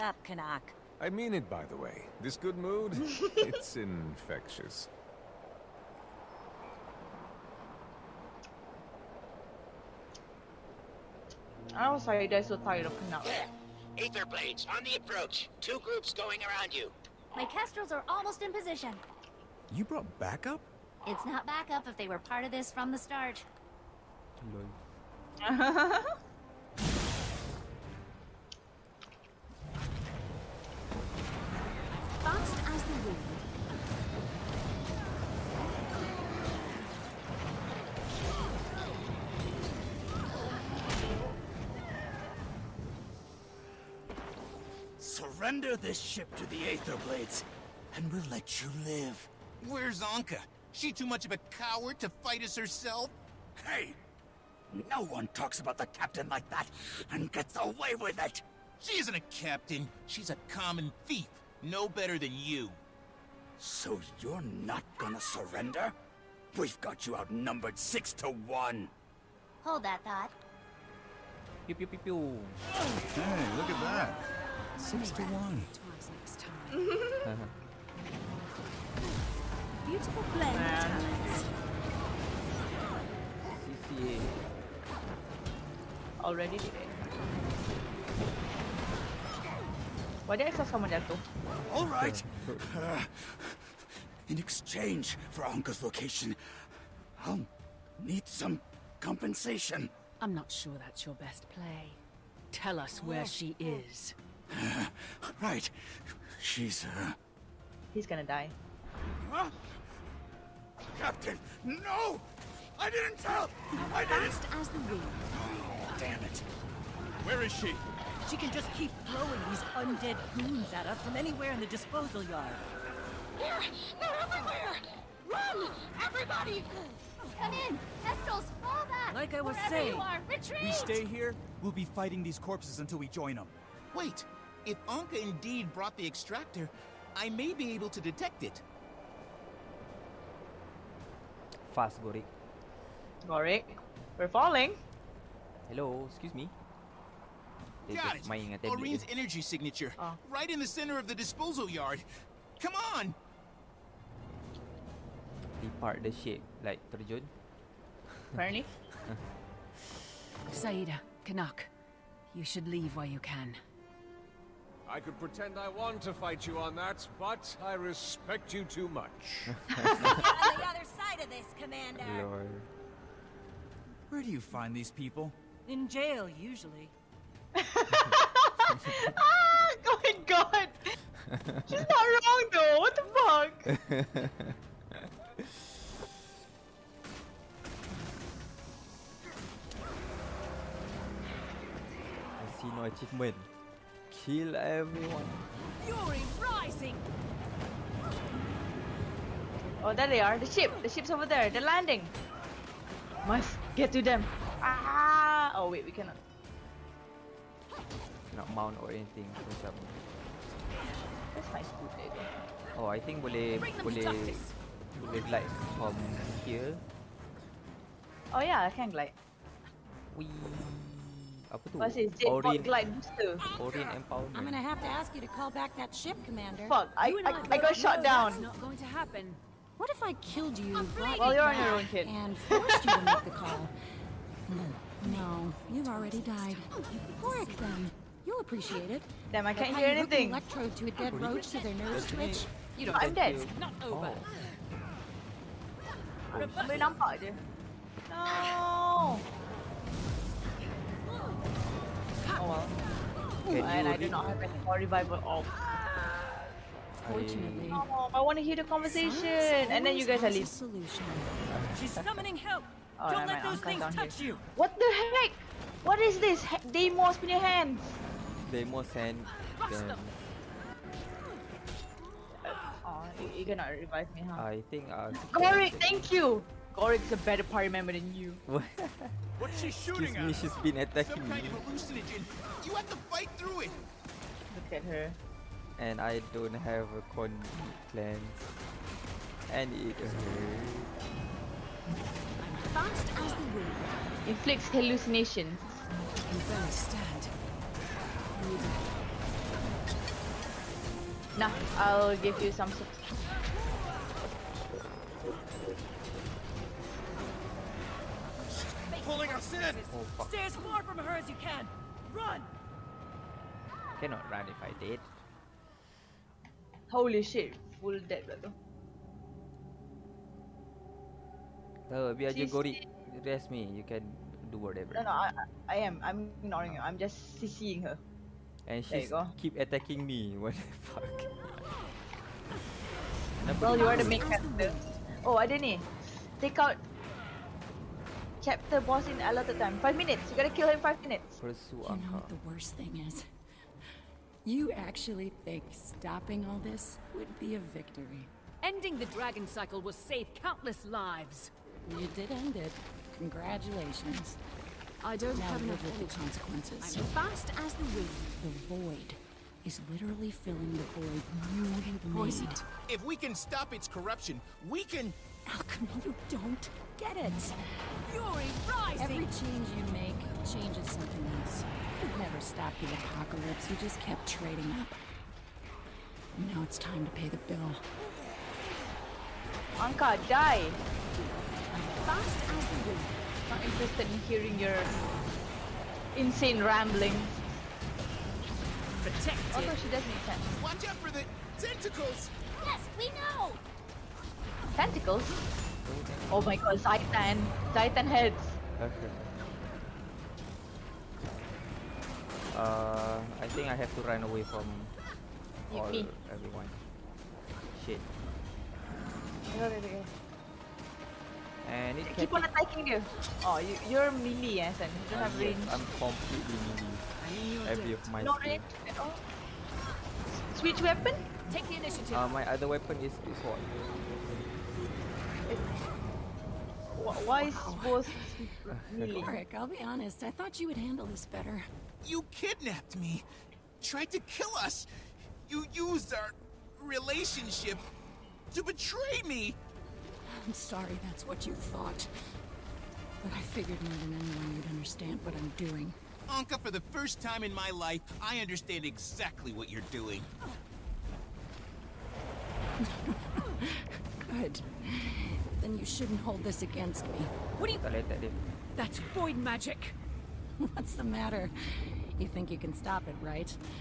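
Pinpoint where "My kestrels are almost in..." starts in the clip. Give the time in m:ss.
0:17.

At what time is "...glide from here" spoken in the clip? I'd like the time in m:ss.
3:35.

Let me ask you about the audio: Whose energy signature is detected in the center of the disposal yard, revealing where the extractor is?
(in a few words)
Aurene.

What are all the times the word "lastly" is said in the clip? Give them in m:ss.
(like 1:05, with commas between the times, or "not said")
not said.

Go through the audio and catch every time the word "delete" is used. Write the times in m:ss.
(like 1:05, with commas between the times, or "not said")
not said.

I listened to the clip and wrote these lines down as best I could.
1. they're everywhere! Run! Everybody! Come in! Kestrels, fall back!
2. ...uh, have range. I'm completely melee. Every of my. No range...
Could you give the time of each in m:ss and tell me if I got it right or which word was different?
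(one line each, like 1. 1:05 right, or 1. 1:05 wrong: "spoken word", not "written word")
1. 2:04 right
2. 6:55 right.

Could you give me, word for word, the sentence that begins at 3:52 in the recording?
And forced you to make the call.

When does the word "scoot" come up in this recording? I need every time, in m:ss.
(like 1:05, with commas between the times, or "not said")
3:31.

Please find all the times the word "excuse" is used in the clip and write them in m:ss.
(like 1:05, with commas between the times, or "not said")
2:26, 4:40.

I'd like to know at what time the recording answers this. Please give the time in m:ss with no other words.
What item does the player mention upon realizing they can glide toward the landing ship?
3:42.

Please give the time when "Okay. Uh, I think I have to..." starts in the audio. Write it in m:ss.
6:38.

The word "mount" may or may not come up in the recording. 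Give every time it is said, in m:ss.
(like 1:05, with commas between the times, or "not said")
3:28.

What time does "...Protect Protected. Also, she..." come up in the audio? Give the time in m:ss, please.
6:26.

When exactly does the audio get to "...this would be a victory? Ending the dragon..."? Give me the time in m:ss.
5:46.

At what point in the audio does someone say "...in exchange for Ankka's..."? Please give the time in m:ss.
1:34.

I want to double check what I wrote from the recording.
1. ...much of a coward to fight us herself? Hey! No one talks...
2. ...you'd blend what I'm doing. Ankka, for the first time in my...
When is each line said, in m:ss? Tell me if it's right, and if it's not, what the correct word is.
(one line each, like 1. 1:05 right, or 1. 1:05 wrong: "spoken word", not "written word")
1. 0:51 right
2. 7:24 wrong: "understand", not "blend".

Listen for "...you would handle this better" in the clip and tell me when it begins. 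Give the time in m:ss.
7:10.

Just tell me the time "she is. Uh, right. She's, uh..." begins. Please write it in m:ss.
1:43.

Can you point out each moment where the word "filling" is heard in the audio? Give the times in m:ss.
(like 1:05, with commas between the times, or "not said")
6:00.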